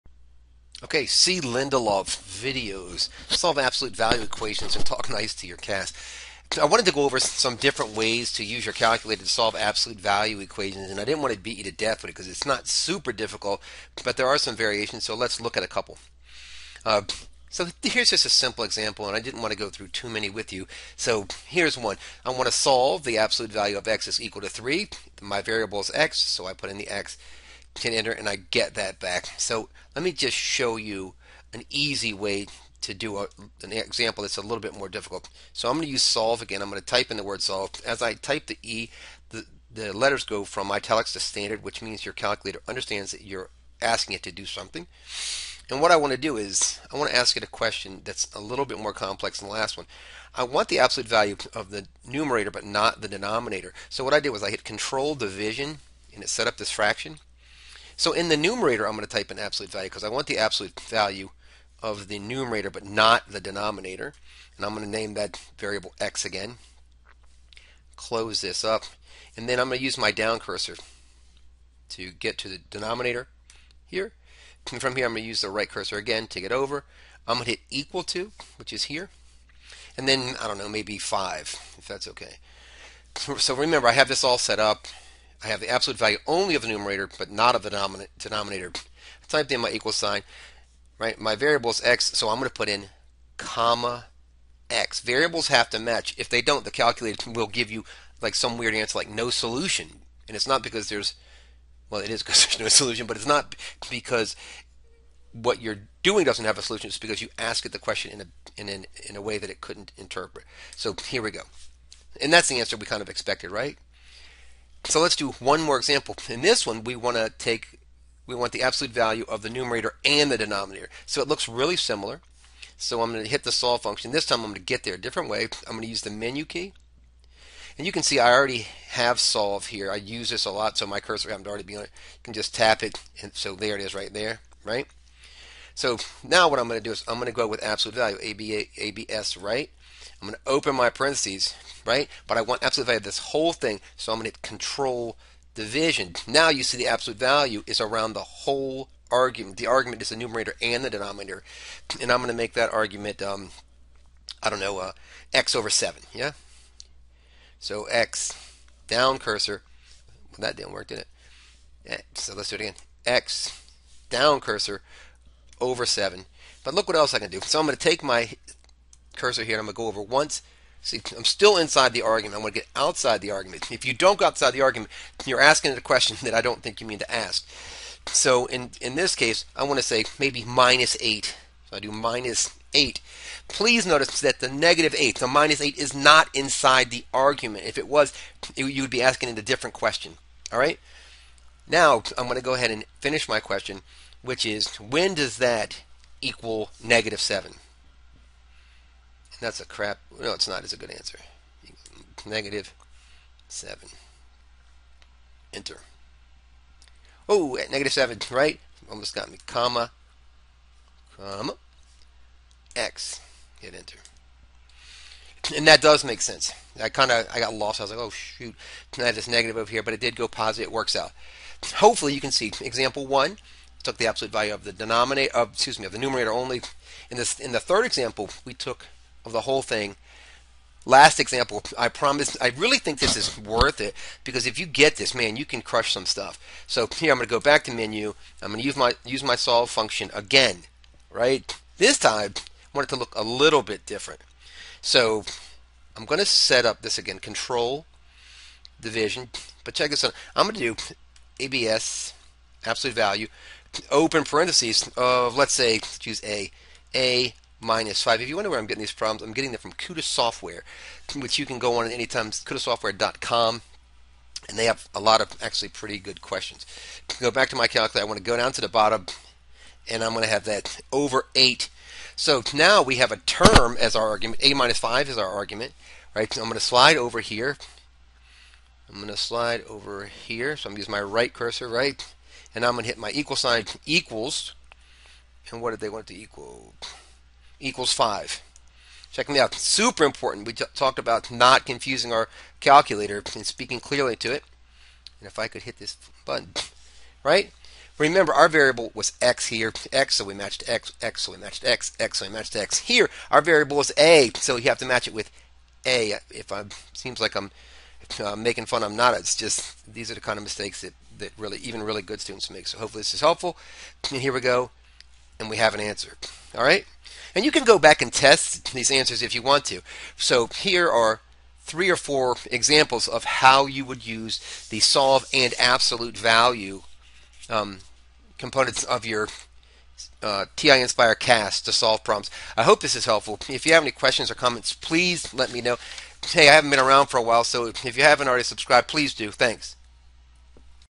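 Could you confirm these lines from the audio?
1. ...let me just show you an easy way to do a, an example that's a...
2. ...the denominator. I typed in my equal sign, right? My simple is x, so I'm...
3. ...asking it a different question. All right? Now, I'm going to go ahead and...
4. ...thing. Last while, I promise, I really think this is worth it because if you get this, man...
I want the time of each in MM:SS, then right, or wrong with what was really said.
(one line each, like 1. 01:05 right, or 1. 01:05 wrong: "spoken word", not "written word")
1. 00:29 right
2. 01:27 wrong: "variable", not "simple"
3. 03:09 right
4. 03:49 wrong: "example", not "while".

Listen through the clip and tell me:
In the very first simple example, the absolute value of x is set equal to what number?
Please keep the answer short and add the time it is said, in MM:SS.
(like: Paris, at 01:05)
3, at 00:24.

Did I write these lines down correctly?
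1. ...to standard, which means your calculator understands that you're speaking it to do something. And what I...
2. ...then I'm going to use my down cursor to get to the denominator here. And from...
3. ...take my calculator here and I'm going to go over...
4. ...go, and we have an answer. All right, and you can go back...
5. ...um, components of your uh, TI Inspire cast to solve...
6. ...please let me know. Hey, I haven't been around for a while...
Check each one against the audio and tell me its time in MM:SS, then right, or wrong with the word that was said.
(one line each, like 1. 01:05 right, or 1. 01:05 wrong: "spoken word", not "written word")
1. 00:41 wrong: "asking", not "speaking"
2. 01:09 right
3. 02:47 wrong: "cursor", not "calculator"
4. 05:14 right
5. 05:27 right
6. 05:34 right.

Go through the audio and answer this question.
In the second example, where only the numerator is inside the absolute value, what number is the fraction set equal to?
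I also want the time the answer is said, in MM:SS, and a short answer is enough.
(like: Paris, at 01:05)
5, at 01:20.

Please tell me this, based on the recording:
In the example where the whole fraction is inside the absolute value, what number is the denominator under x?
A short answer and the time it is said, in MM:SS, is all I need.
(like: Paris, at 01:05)
7, at 02:35.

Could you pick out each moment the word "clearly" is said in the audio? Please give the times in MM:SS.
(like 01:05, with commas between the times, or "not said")
04:53.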